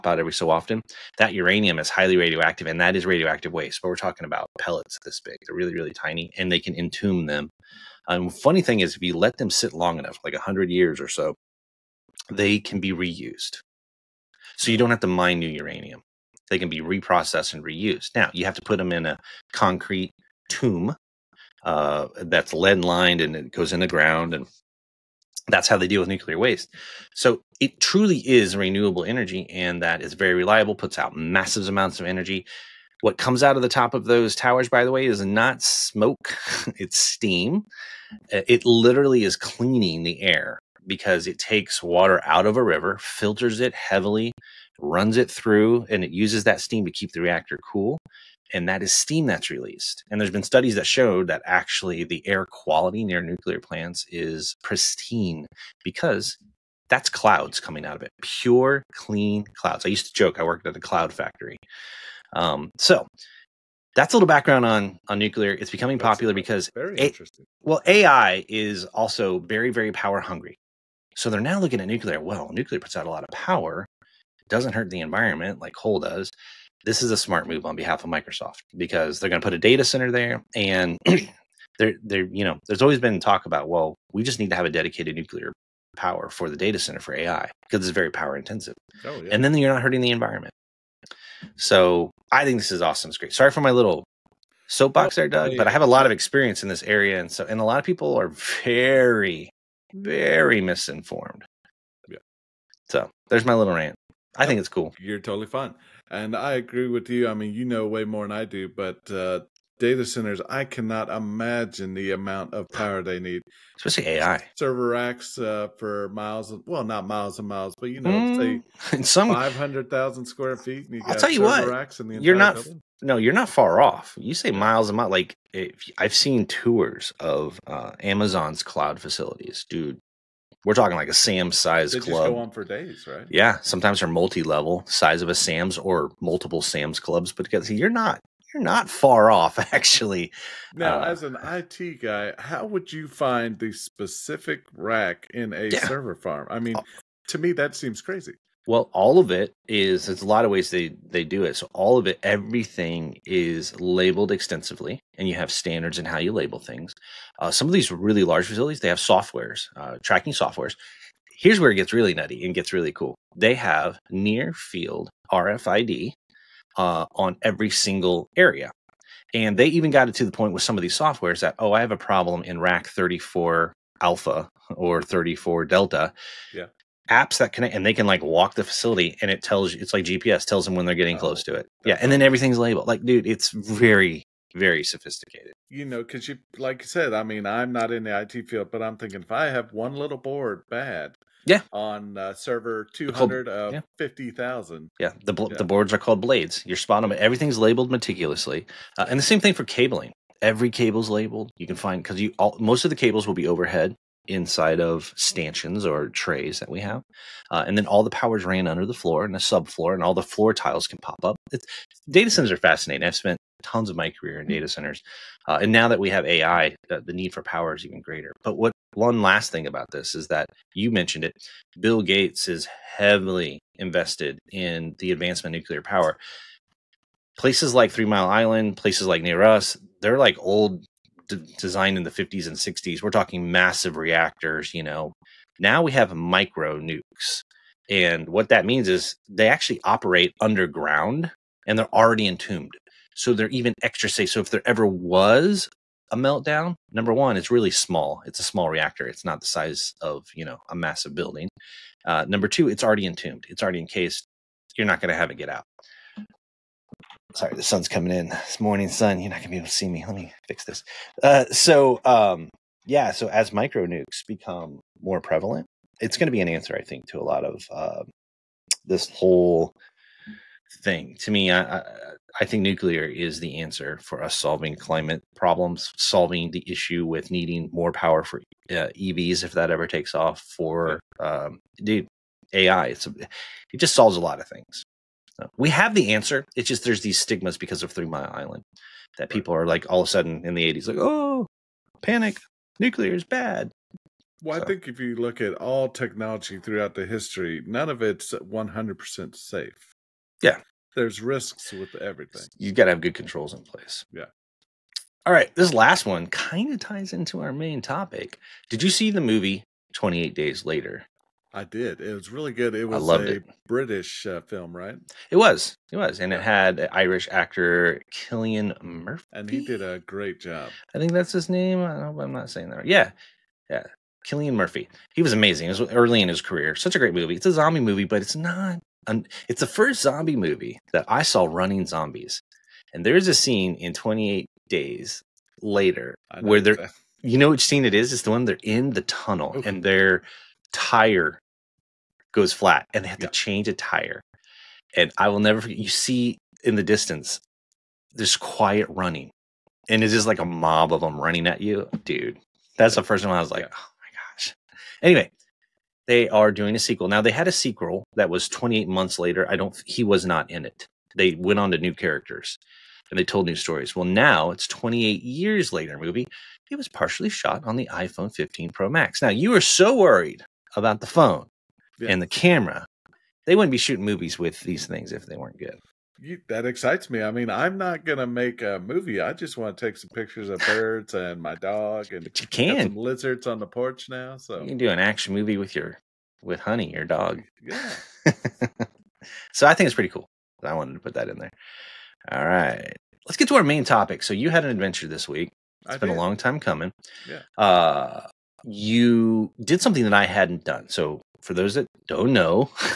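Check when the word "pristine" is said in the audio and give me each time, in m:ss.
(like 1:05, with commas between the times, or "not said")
0:54.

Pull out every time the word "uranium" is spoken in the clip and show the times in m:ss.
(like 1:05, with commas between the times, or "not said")
0:01, 0:15.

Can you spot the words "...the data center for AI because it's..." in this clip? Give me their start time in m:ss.
1:26.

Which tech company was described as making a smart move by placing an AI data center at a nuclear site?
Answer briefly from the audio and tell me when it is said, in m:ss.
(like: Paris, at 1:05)
Microsoft, at 1:18.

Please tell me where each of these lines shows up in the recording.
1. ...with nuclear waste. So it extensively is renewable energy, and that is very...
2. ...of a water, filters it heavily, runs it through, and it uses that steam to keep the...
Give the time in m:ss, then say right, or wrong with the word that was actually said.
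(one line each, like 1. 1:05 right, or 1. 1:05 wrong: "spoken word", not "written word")
1. 0:26 wrong: "truly", not "extensively"
2. 0:42 wrong: "river", not "water".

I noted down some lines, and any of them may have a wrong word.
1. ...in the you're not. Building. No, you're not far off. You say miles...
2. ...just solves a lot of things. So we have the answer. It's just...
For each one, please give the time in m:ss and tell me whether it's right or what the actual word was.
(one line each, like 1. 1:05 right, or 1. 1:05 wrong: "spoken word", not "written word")
1. 2:01 right
2. 4:43 right.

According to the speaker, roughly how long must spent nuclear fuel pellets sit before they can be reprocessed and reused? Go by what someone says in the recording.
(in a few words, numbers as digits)
100 years.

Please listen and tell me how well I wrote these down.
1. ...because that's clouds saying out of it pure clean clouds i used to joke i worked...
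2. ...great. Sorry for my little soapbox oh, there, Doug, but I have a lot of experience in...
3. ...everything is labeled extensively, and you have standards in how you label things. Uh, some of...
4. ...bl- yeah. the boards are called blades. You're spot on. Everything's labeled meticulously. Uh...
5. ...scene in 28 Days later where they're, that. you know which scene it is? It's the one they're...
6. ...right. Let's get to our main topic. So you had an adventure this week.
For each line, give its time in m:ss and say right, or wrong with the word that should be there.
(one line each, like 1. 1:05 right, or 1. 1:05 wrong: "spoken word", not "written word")
1. 0:55 wrong: "coming", not "saying"
2. 1:33 right
3. 2:32 right
4. 3:15 right
5. 5:33 right
6. 6:32 right.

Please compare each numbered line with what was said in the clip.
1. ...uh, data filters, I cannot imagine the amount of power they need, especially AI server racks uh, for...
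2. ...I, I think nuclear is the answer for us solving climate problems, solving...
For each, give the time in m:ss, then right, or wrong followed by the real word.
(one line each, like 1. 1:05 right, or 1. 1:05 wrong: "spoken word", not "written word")
1. 1:49 wrong: "centers", not "filters"
2. 4:31 right.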